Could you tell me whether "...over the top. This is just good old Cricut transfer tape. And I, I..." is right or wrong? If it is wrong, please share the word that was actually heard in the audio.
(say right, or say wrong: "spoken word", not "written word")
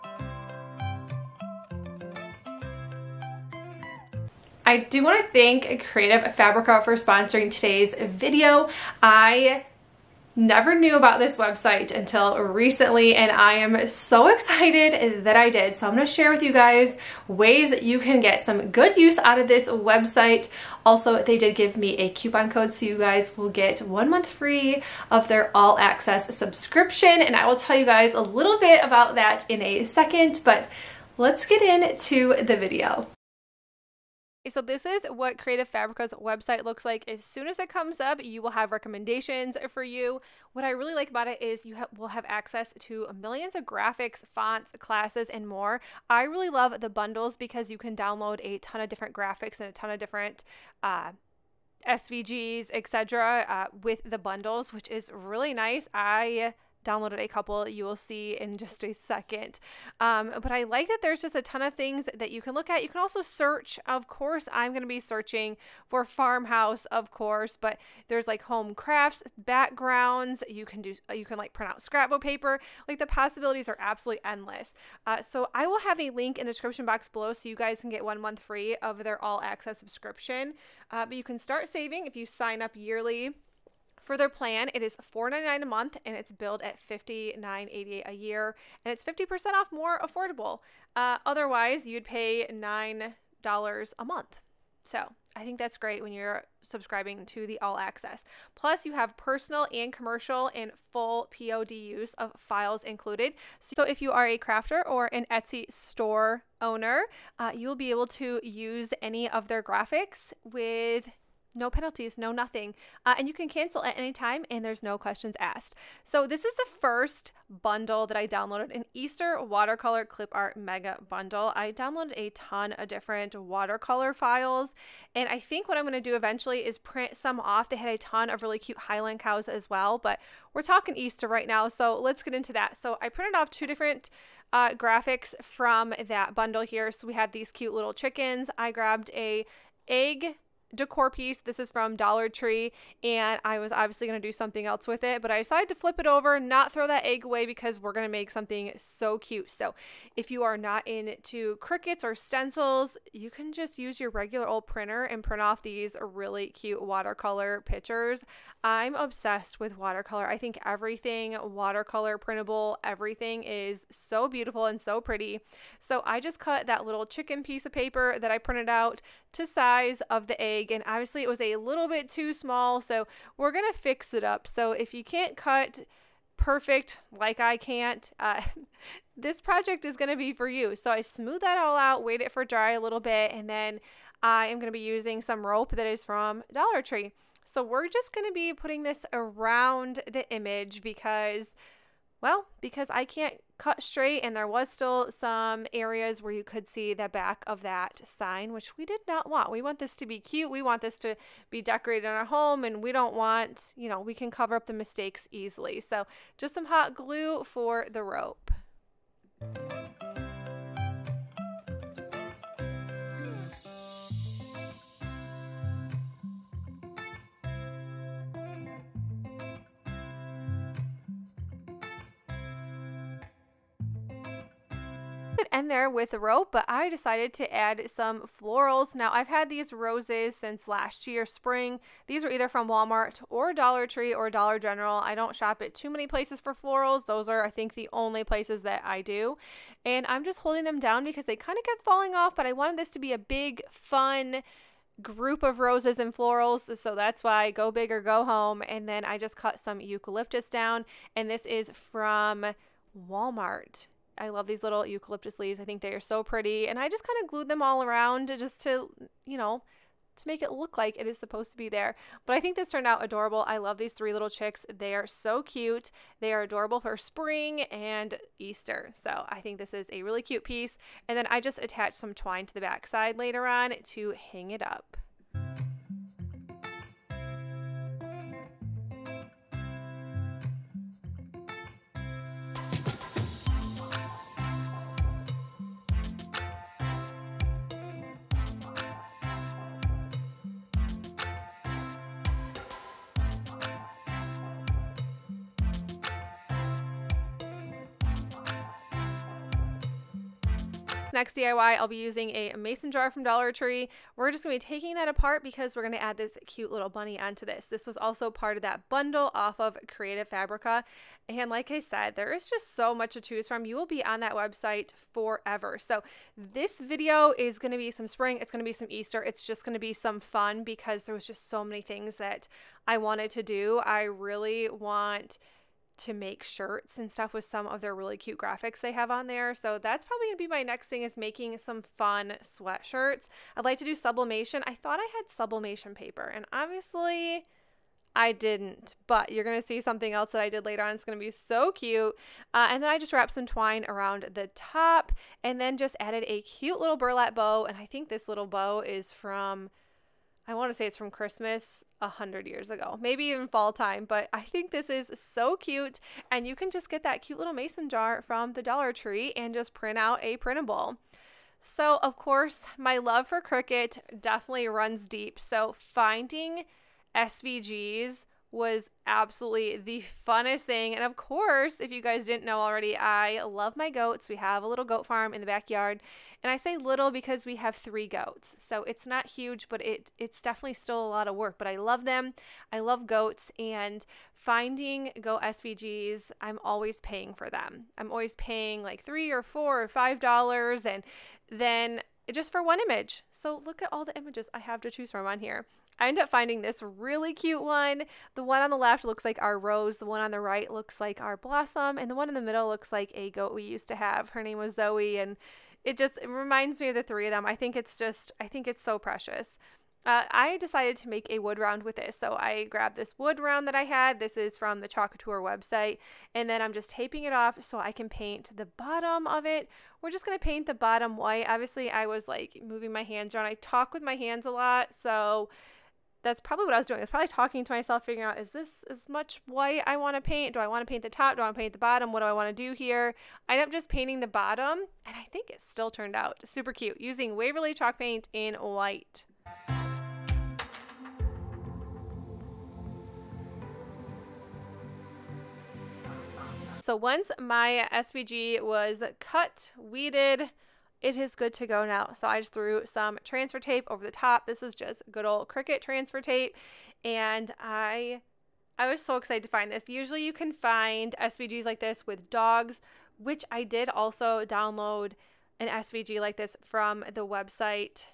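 right.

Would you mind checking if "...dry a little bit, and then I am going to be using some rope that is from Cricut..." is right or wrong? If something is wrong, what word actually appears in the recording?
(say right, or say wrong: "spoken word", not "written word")
wrong: "Dollar", not "Cricut".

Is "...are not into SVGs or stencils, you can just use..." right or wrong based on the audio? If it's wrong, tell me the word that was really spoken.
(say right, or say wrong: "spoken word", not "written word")
wrong: "Cricuts", not "SVGs".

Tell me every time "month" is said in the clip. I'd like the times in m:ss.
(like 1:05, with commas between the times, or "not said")
0:24, 1:18, 1:25, 1:34.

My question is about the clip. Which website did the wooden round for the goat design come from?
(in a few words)
Chalk Couture.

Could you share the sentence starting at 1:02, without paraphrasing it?
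You can also search, of course.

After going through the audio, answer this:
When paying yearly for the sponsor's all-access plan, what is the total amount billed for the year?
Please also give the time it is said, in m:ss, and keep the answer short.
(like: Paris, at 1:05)
$59.88, at 1:26.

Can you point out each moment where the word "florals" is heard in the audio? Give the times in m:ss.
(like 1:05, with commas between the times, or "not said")
3:48, 3:56, 4:06.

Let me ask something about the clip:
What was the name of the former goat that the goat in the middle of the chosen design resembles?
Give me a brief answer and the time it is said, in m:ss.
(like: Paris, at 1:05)
Zoe, at 6:44.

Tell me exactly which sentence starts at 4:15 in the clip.
I think they are so pretty.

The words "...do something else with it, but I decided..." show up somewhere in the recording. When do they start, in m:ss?
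2:24.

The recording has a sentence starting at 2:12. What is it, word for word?
So, I printed off two different uh, graphics from that bundle here.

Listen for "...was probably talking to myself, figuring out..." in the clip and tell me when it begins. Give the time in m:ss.
7:07.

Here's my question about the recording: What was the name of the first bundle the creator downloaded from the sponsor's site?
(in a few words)
Easter watercolor clip art mega bundle.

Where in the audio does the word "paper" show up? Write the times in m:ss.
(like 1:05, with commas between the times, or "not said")
1:12, 2:47, 5:35.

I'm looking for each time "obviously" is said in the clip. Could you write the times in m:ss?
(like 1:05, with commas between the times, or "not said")
2:23, 2:50, 5:36, 7:01.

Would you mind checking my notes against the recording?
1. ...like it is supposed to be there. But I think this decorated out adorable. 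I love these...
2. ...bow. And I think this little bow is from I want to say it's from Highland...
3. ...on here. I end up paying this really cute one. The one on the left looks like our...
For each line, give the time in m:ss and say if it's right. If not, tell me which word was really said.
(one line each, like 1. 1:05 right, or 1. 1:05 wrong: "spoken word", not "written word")
1. 4:20 wrong: "turned", not "decorated"
2. 5:47 wrong: "Christmas", not "Highland"
3. 6:35 wrong: "finding", not "paying".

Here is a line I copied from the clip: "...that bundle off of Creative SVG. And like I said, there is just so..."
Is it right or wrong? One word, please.
wrong.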